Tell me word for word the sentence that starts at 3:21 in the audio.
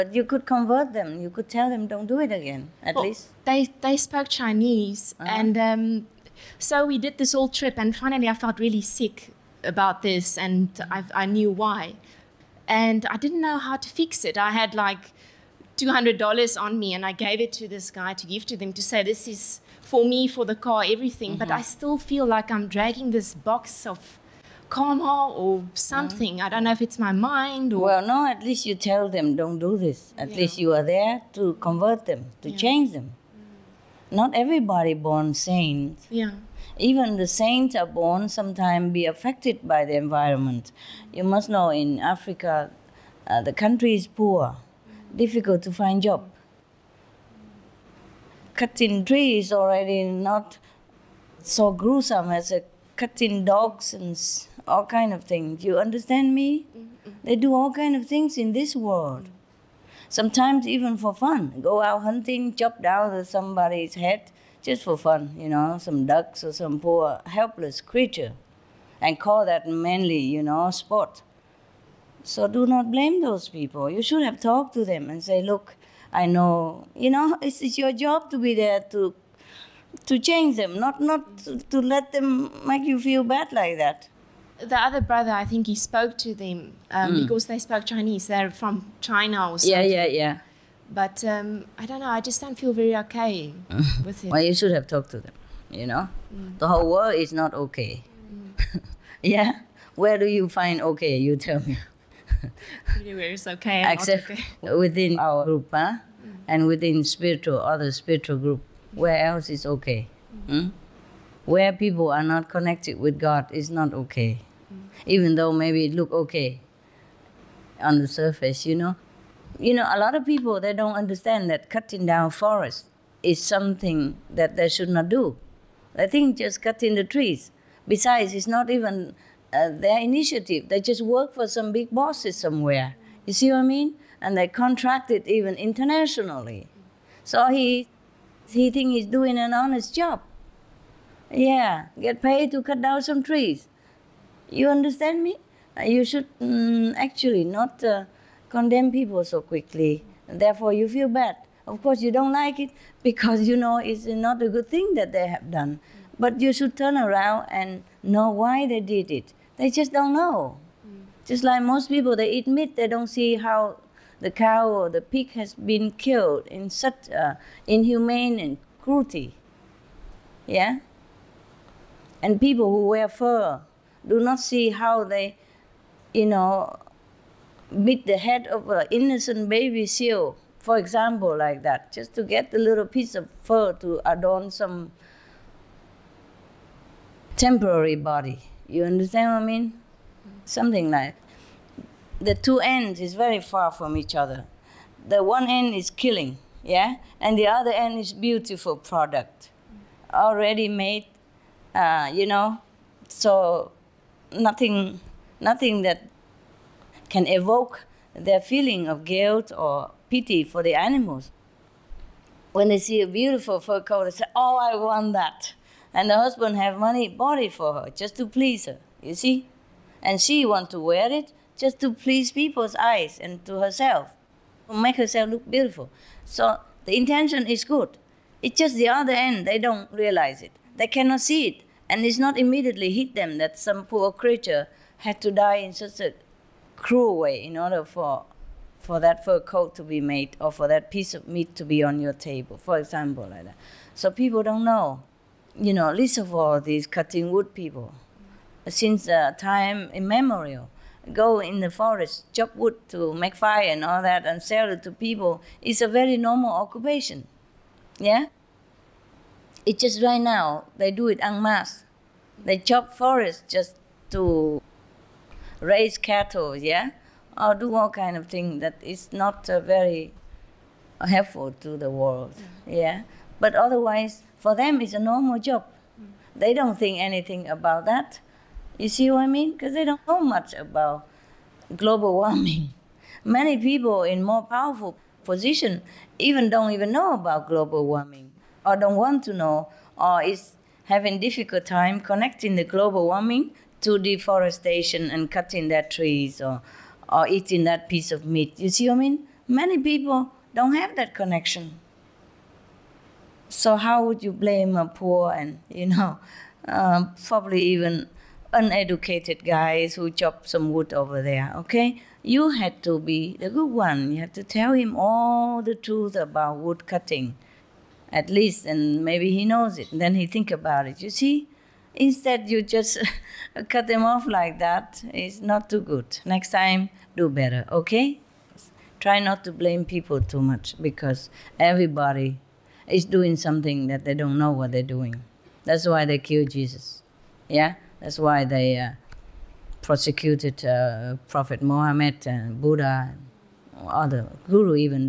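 Uh, you know, so nothing, nothing that can evoke their feeling of guilt or pity for the animals.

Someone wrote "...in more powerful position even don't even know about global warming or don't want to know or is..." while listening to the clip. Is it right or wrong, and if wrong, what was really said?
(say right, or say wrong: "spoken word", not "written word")
right.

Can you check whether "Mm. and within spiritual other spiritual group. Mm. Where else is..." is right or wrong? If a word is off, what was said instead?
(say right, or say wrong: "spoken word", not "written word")
right.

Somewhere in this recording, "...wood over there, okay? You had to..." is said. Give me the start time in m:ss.
5:10.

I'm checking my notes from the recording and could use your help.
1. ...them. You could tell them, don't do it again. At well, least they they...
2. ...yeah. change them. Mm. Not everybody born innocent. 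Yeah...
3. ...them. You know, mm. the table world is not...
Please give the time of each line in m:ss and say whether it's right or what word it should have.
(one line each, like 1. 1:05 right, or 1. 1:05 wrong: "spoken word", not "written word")
1. 0:00 right
2. 0:32 wrong: "saint", not "innocent"
3. 1:35 wrong: "whole", not "table".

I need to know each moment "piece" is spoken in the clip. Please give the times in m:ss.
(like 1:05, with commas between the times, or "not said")
3:02, 4:00, 4:57.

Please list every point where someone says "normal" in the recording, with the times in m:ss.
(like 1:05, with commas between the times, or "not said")
4:16, 4:34.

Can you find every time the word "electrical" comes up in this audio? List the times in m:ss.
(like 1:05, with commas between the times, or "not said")
not said.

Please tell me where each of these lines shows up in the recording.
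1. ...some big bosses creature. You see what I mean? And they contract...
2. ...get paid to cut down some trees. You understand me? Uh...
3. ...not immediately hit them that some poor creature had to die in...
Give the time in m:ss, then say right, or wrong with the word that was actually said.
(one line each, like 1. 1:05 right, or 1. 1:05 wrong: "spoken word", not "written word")
1. 2:11 wrong: "somewhere", not "creature"
2. 2:22 right
3. 3:52 right.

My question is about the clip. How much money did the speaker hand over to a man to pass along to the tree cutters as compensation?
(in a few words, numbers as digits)
$200.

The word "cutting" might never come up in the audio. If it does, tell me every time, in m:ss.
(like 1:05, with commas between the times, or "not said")
0:48, 0:52, 2:01, 2:06, 4:06, 4:55, 5:16.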